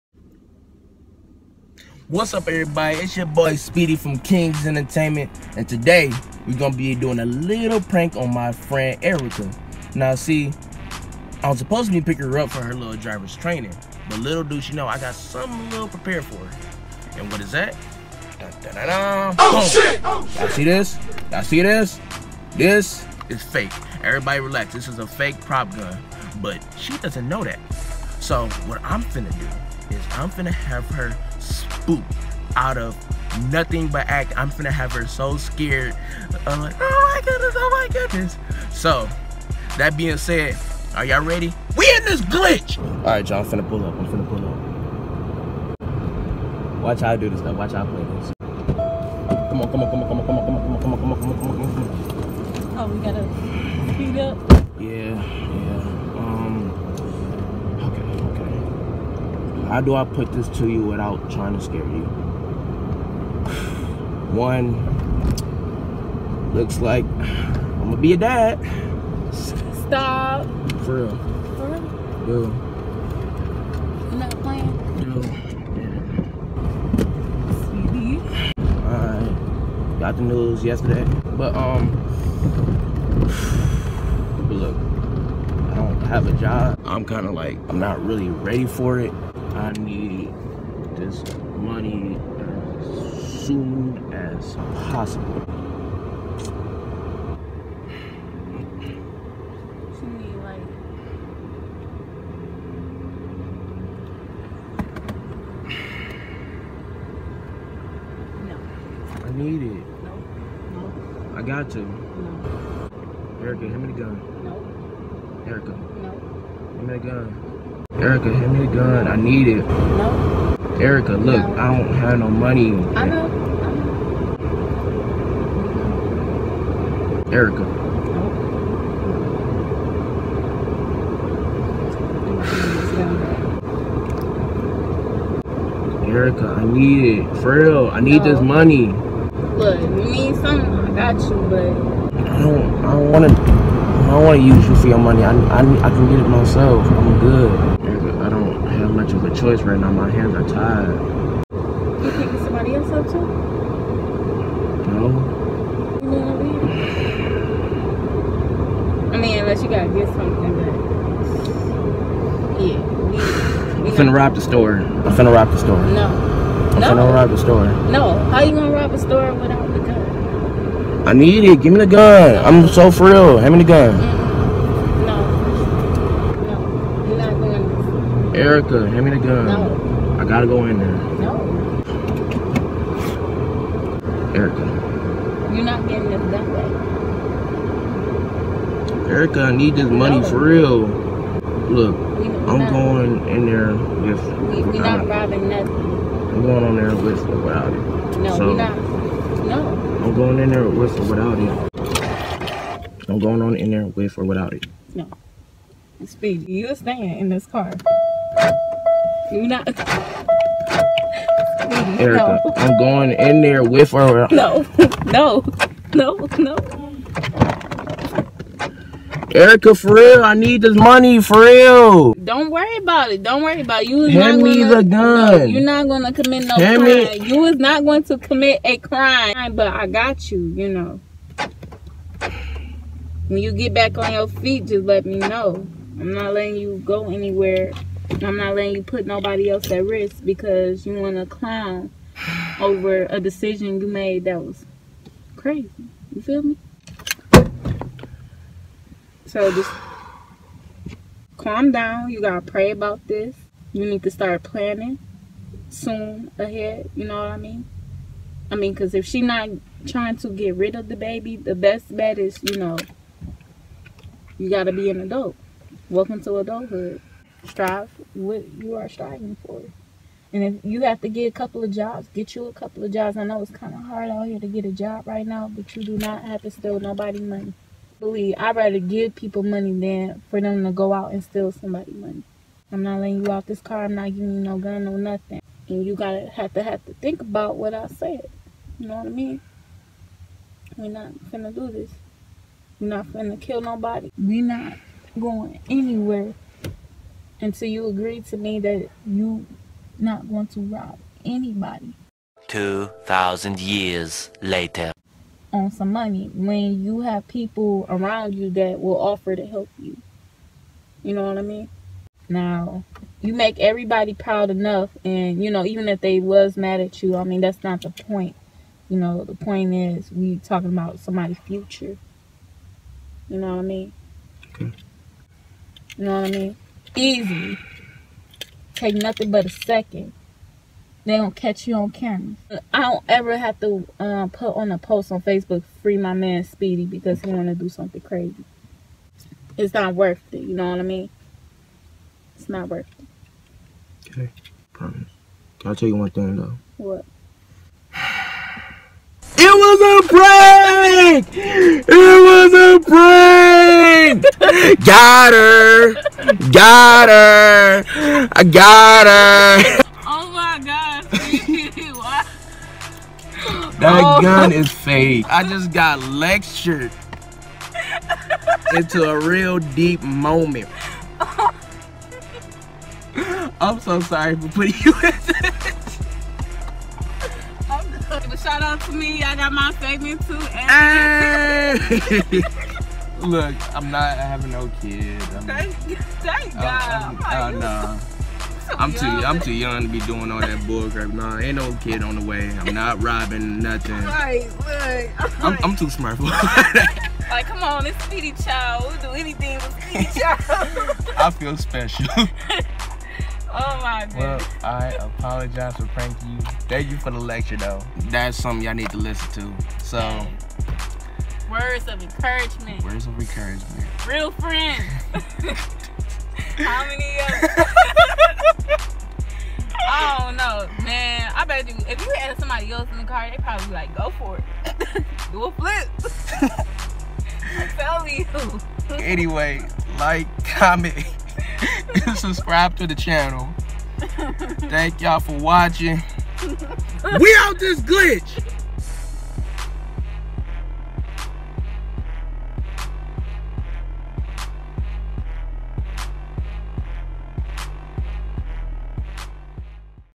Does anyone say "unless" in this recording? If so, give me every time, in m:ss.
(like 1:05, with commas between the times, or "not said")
2:39.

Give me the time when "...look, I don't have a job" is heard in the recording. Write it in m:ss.
1:24.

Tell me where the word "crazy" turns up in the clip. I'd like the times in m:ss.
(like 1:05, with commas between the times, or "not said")
4:05, 5:38.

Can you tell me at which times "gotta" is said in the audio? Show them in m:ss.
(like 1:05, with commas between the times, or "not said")
0:53, 2:39, 3:00, 4:45.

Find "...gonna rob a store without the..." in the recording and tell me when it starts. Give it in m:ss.
2:48.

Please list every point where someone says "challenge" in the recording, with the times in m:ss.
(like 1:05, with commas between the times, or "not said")
not said.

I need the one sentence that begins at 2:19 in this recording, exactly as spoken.
Look, you need something, I got you, but...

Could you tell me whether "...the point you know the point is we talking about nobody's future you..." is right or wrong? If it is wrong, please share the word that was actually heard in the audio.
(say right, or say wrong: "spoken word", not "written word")
wrong: "somebody", not "nobody".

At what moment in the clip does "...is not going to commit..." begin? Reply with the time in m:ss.
3:47.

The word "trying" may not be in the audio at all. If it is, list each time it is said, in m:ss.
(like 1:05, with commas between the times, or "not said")
1:01, 4:19.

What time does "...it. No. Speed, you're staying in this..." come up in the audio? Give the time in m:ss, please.
3:24.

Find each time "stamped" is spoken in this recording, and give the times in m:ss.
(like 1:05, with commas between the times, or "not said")
not said.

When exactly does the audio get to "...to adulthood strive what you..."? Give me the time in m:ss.
4:26.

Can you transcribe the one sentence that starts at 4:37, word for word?
Believe, I'd rather give people money than for them to go out and steal somebody money.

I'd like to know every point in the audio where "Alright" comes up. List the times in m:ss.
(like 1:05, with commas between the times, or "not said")
0:42, 1:18.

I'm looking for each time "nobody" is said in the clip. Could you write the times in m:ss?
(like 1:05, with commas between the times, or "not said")
3:59, 4:36, 4:53.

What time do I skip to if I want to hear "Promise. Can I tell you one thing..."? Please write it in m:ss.
5:44.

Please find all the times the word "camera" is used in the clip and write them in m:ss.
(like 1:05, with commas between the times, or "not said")
5:31.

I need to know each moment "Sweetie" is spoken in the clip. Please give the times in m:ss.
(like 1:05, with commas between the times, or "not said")
1:17.